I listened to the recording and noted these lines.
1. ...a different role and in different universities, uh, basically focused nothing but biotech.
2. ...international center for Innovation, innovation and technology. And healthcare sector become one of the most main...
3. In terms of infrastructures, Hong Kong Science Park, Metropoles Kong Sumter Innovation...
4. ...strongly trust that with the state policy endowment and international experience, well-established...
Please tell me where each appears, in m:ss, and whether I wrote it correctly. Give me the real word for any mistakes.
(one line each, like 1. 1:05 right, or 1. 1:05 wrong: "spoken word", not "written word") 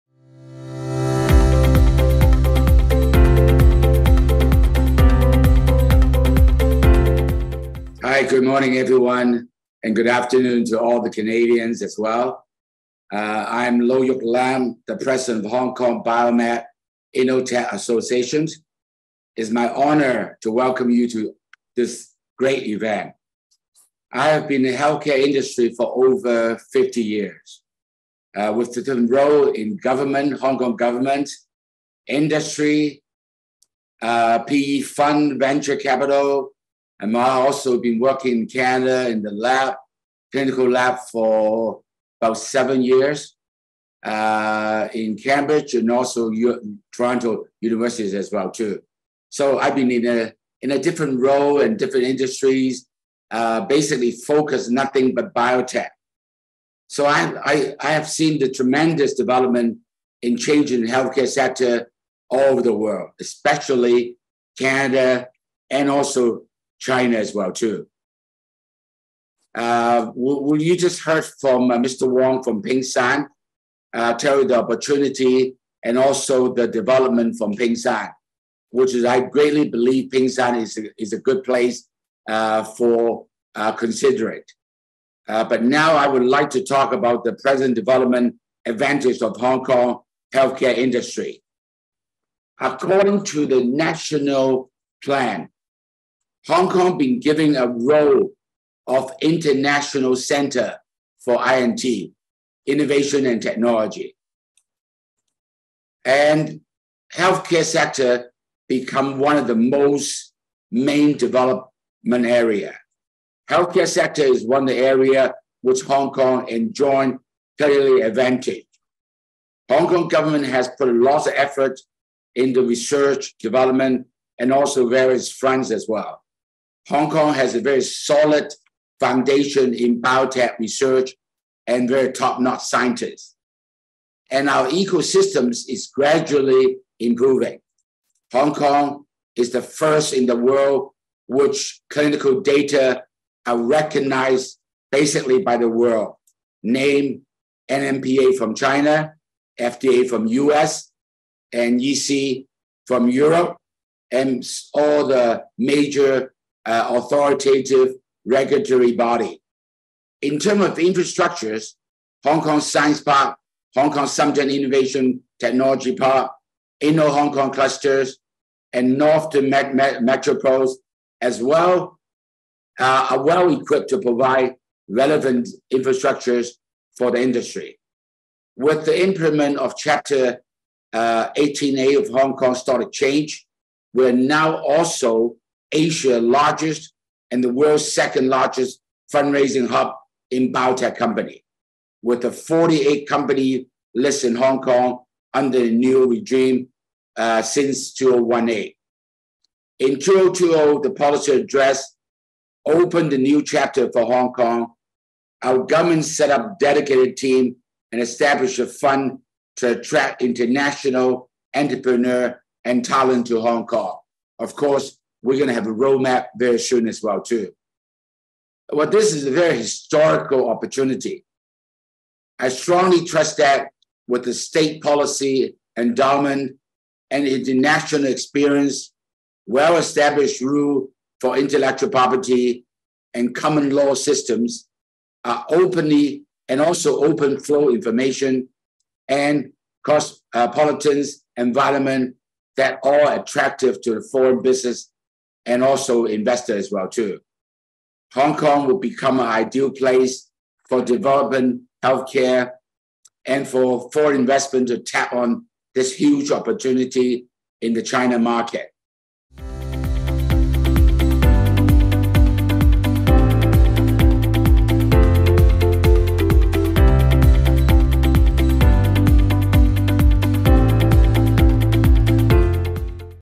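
1. 0:50 wrong: "industries", not "universities"
2. 1:39 wrong: "INT", not "Innovation"
3. 2:40 wrong: "Hong", not "Metropoles"
4. 3:42 right.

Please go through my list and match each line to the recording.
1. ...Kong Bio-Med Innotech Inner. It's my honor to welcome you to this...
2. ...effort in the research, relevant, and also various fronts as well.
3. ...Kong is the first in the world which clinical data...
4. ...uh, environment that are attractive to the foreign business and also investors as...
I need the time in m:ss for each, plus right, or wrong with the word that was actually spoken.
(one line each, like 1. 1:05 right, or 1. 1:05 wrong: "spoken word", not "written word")
1. 0:15 wrong: "Associations", not "Inner"
2. 2:01 wrong: "development", not "relevant"
3. 2:18 right
4. 4:00 right.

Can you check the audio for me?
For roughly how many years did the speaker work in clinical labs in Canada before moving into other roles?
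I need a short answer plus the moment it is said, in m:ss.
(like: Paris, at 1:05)
7 years, at 0:42.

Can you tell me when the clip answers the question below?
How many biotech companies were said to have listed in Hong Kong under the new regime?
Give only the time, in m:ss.
3:12.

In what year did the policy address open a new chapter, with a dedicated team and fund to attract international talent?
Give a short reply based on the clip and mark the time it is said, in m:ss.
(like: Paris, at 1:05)
2020, at 3:19.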